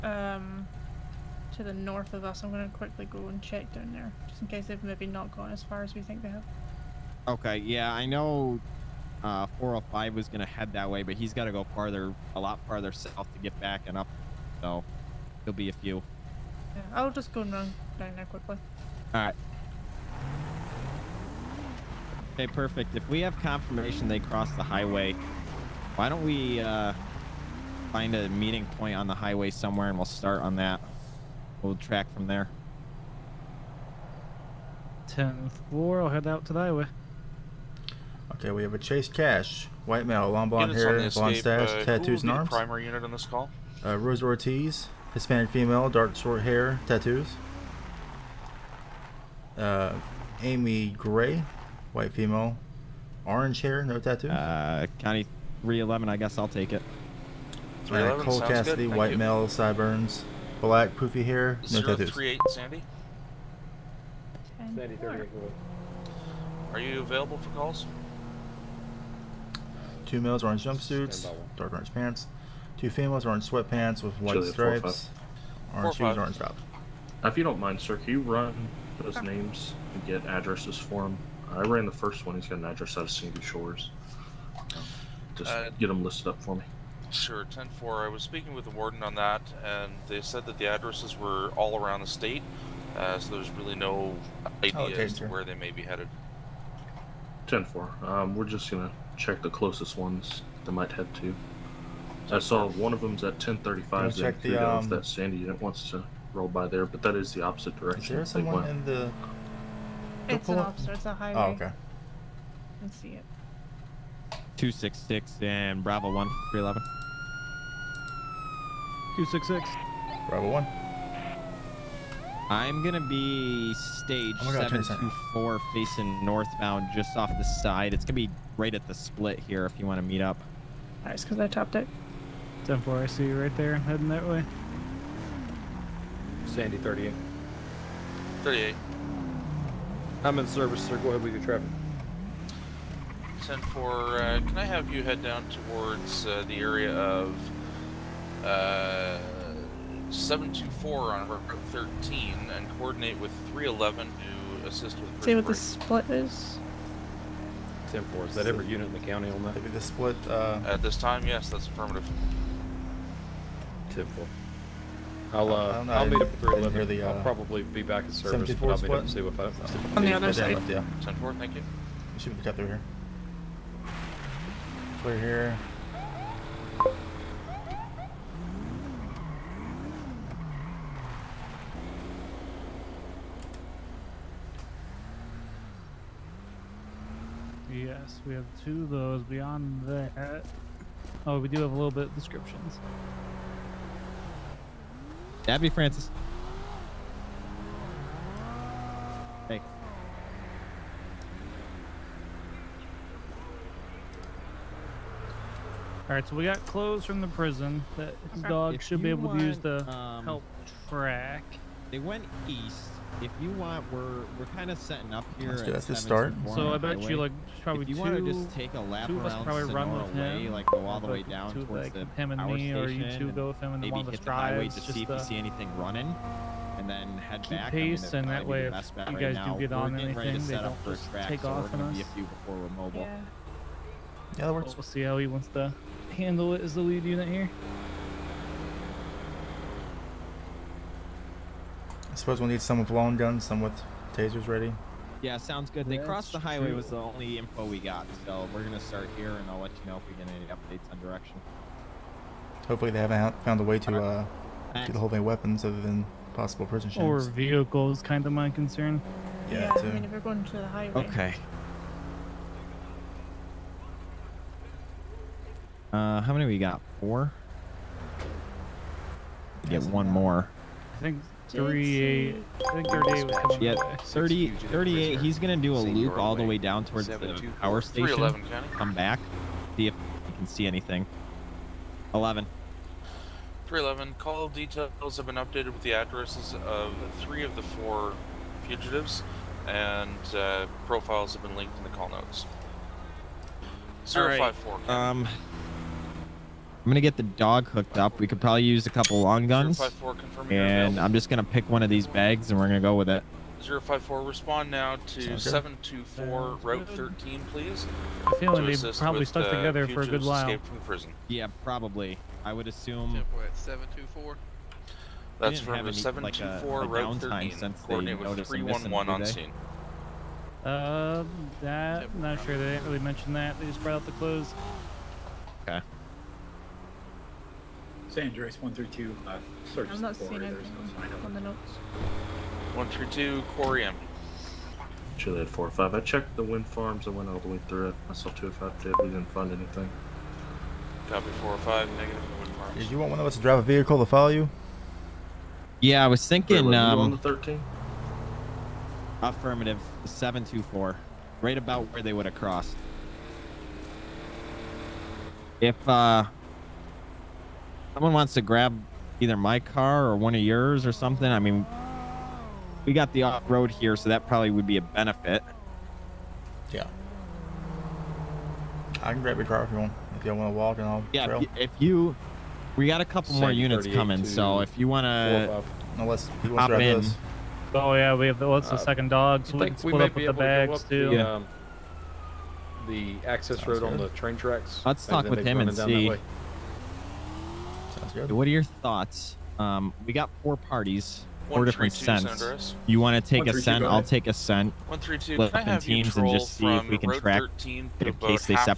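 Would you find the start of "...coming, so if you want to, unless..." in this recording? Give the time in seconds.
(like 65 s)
373 s.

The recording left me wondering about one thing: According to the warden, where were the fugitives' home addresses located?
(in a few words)
all around the state.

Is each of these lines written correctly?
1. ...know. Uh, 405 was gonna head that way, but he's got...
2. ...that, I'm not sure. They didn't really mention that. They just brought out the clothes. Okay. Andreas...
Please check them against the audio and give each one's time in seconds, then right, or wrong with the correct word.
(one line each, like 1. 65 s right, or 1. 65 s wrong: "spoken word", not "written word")
1. 8 s right
2. 321 s right.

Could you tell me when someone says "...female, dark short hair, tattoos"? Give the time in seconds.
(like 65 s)
45 s.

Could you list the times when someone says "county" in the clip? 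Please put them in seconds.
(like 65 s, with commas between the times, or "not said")
54 s, 159 s.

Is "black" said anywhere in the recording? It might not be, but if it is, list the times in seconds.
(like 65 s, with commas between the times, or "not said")
60 s.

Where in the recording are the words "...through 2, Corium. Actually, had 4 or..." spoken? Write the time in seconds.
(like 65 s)
332 s.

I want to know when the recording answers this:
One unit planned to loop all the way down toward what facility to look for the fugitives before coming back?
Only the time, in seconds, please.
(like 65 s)
277 s.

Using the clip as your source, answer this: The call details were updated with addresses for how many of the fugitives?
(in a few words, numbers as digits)
3.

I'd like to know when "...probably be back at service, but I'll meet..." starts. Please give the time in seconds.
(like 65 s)
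167 s.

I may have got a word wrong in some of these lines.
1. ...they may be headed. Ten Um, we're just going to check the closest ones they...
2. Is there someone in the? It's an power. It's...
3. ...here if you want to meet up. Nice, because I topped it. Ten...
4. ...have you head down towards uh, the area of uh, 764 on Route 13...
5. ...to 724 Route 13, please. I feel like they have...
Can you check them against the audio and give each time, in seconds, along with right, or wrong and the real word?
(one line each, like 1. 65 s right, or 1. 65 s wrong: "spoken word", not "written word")
1. 95 s right
2. 108 s wrong: "officer", not "power"
3. 129 s right
4. 144 s wrong: "724", not "764"
5. 305 s right.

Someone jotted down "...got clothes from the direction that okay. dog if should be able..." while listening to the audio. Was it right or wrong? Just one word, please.
wrong.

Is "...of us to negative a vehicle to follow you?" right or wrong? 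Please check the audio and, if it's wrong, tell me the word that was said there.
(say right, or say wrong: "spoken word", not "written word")
wrong: "drive", not "negative".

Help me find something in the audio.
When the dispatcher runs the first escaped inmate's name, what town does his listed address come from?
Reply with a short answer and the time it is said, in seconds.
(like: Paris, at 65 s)
Sandy Shores, at 83 s.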